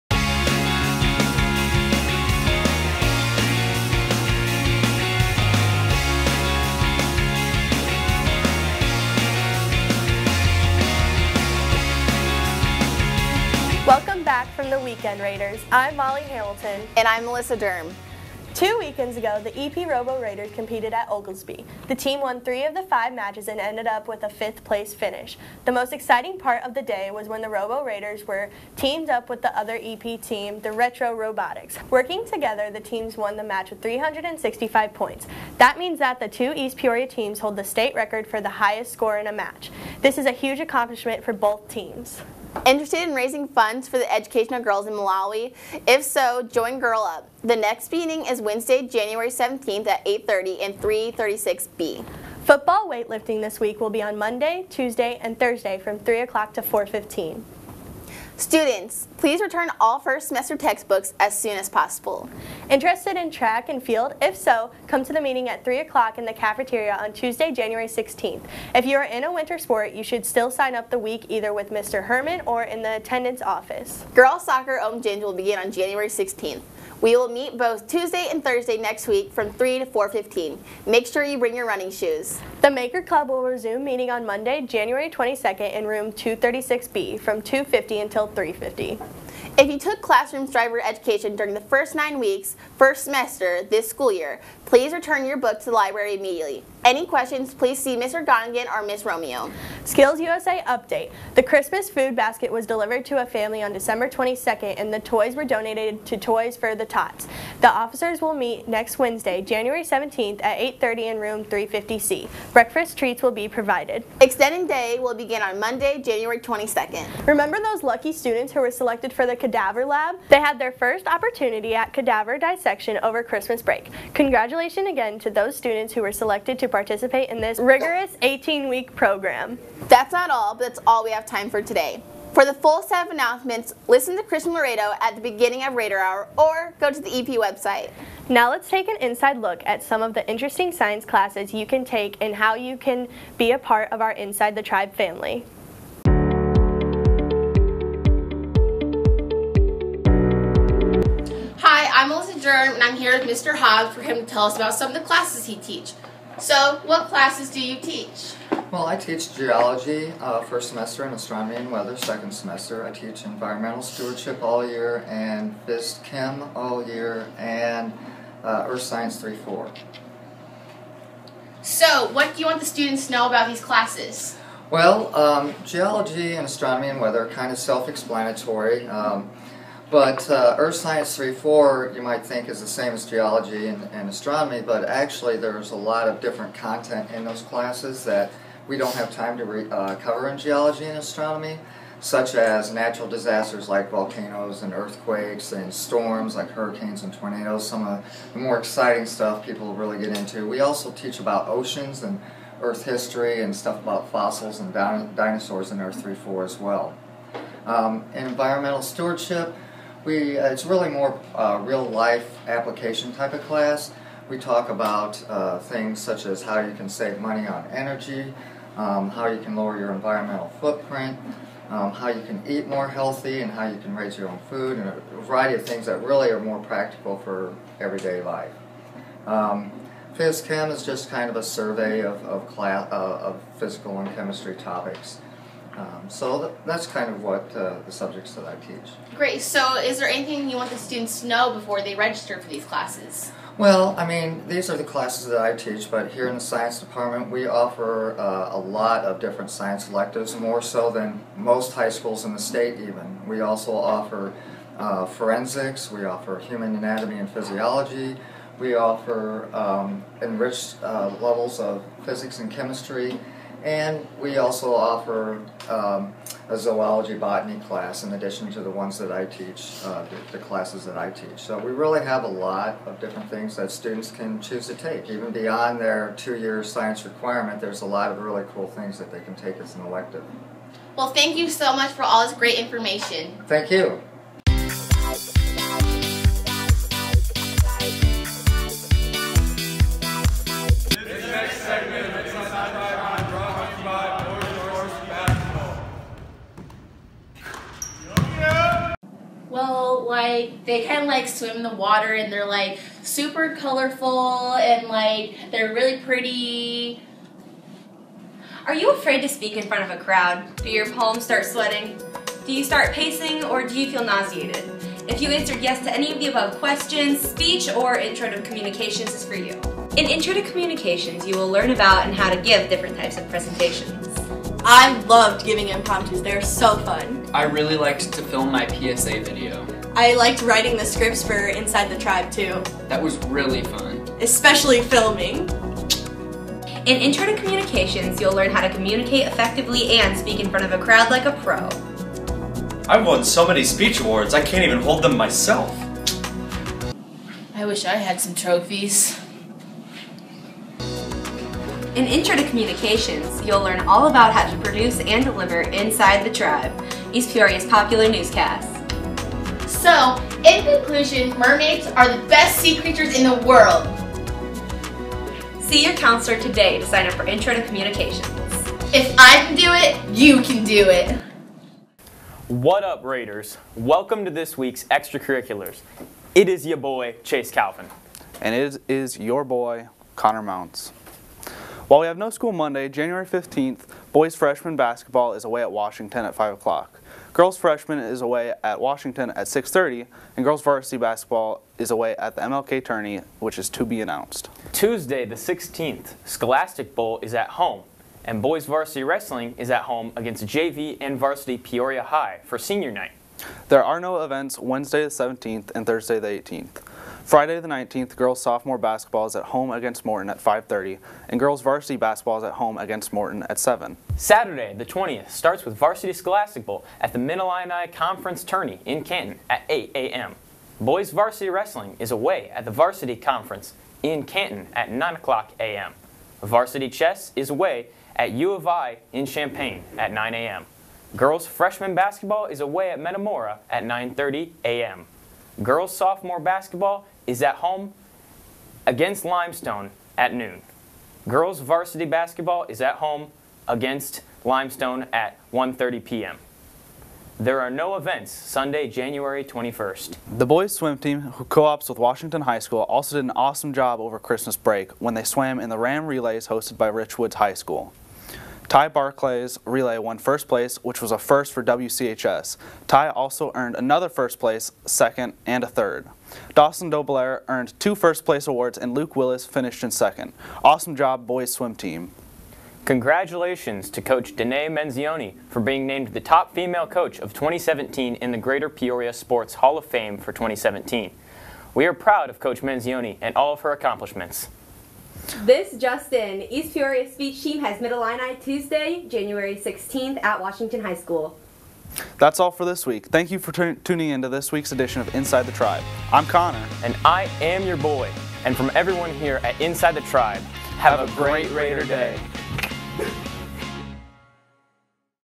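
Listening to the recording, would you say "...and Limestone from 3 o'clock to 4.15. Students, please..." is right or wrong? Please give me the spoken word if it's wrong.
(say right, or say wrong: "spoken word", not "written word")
wrong: "Thursday", not "Limestone".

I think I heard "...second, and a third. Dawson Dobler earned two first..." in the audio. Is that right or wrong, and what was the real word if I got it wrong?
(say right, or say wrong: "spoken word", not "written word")
right.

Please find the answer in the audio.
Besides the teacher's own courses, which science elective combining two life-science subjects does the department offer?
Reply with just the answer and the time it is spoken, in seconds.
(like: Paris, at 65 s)
Zoology botany, at 266 s.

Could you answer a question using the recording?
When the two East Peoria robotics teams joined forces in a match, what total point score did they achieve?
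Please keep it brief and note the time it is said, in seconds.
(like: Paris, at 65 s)
365, at 33 s.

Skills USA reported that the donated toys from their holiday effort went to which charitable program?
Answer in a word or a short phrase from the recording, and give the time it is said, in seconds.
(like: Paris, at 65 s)
Toys for the Tots, at 106 s.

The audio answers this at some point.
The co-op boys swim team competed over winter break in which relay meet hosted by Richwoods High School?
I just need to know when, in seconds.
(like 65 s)
455 s.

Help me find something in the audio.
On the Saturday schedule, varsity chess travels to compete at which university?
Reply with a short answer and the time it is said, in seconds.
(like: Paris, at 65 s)
U of I, at 428 s.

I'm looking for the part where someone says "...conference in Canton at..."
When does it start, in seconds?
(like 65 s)
423 s.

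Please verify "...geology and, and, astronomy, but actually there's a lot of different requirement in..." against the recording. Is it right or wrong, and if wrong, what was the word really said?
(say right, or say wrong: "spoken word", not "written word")
wrong: "content", not "requirement".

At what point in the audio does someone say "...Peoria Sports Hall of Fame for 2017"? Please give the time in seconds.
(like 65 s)
478 s.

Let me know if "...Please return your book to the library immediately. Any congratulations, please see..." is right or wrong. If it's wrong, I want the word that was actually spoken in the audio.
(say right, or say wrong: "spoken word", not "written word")
wrong: "questions", not "congratulations".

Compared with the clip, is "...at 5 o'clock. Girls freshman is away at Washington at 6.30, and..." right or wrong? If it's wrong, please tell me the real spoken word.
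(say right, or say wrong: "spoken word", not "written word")
right.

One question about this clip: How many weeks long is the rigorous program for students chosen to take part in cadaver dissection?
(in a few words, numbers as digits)
18.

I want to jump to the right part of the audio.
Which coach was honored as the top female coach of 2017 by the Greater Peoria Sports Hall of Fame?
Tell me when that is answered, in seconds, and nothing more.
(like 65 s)
474 s.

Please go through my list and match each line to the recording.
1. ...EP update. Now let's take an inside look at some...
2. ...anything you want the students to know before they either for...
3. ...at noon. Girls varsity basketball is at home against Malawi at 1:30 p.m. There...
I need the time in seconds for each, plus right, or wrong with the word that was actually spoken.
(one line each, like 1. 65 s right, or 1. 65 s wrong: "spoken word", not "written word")
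1. 137 s wrong: "website", not "update"
2. 240 s wrong: "register", not "either"
3. 440 s wrong: "Limestone", not "Malawi".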